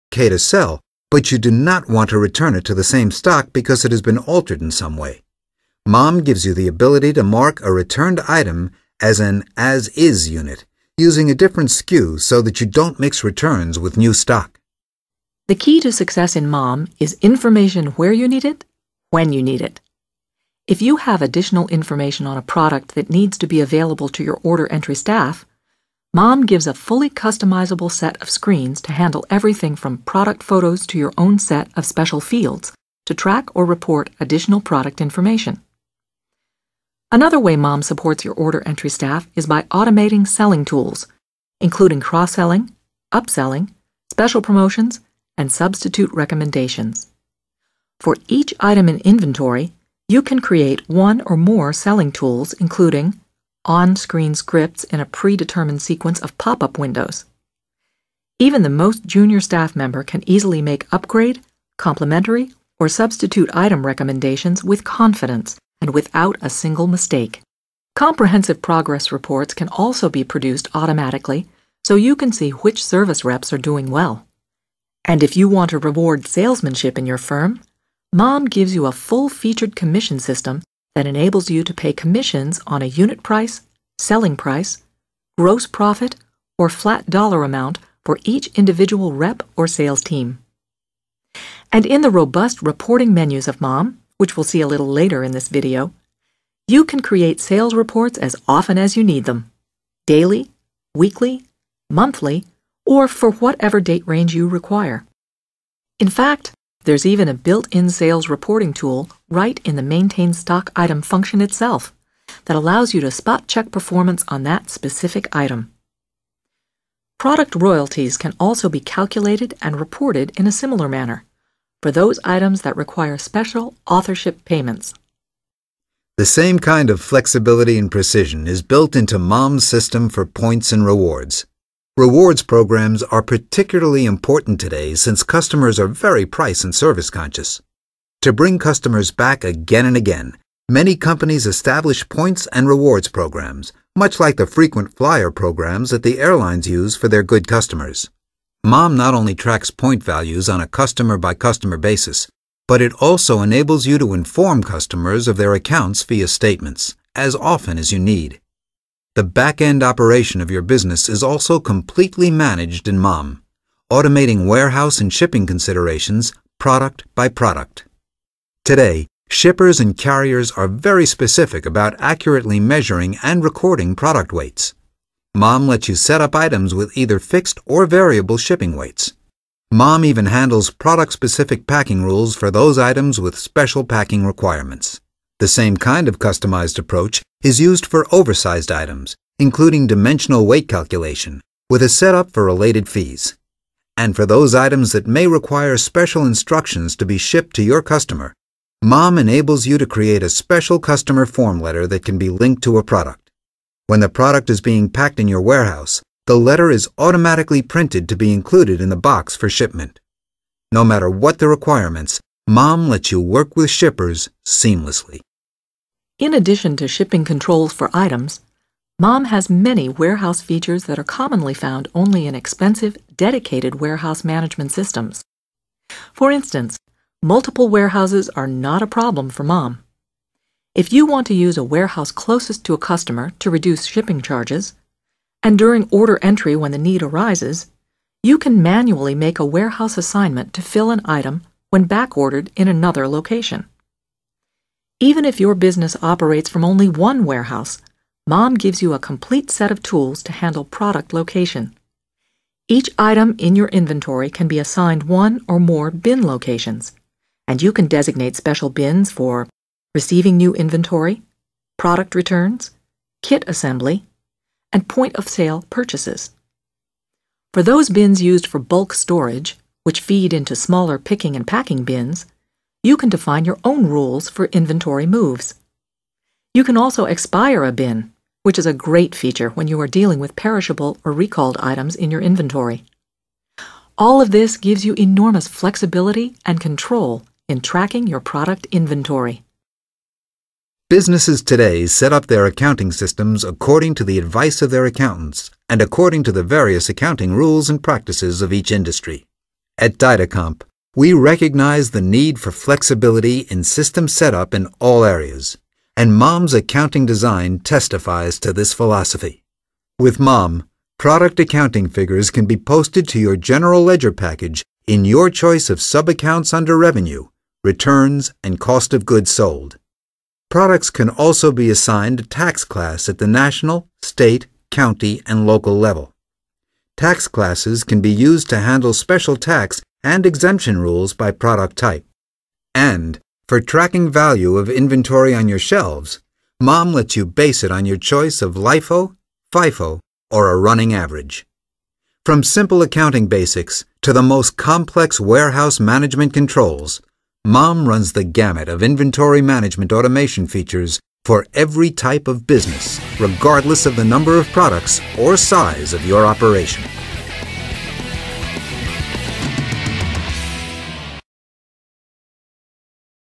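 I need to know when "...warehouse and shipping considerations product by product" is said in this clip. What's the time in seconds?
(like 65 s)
164 s.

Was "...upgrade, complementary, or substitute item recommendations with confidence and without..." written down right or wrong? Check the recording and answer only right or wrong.
right.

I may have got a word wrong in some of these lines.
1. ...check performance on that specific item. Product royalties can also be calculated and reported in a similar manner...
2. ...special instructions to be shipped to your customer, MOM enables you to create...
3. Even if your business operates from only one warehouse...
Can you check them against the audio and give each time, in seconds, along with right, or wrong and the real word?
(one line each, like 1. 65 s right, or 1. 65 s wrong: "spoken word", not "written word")
1. 113 s right
2. 195 s right
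3. 245 s right.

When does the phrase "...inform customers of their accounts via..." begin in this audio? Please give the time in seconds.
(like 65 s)
154 s.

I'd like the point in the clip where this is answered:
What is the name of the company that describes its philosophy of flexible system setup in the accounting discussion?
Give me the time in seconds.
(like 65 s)
299 s.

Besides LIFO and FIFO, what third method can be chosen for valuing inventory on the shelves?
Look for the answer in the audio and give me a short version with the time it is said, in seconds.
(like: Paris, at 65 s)
running average, at 340 s.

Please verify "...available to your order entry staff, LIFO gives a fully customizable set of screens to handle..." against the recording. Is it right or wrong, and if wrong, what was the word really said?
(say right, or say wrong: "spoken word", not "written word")
wrong: "Mom", not "LIFO".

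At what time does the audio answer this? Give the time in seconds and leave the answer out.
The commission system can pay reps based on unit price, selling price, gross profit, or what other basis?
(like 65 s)
86 s.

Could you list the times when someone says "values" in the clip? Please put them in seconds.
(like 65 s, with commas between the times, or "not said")
150 s, 334 s.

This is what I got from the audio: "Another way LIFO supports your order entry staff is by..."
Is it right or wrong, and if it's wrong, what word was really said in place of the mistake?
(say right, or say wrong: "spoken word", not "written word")
wrong: "Mom", not "LIFO".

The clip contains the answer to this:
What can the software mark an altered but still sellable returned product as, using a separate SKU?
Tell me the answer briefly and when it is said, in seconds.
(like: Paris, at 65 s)
as is unit, at 9 s.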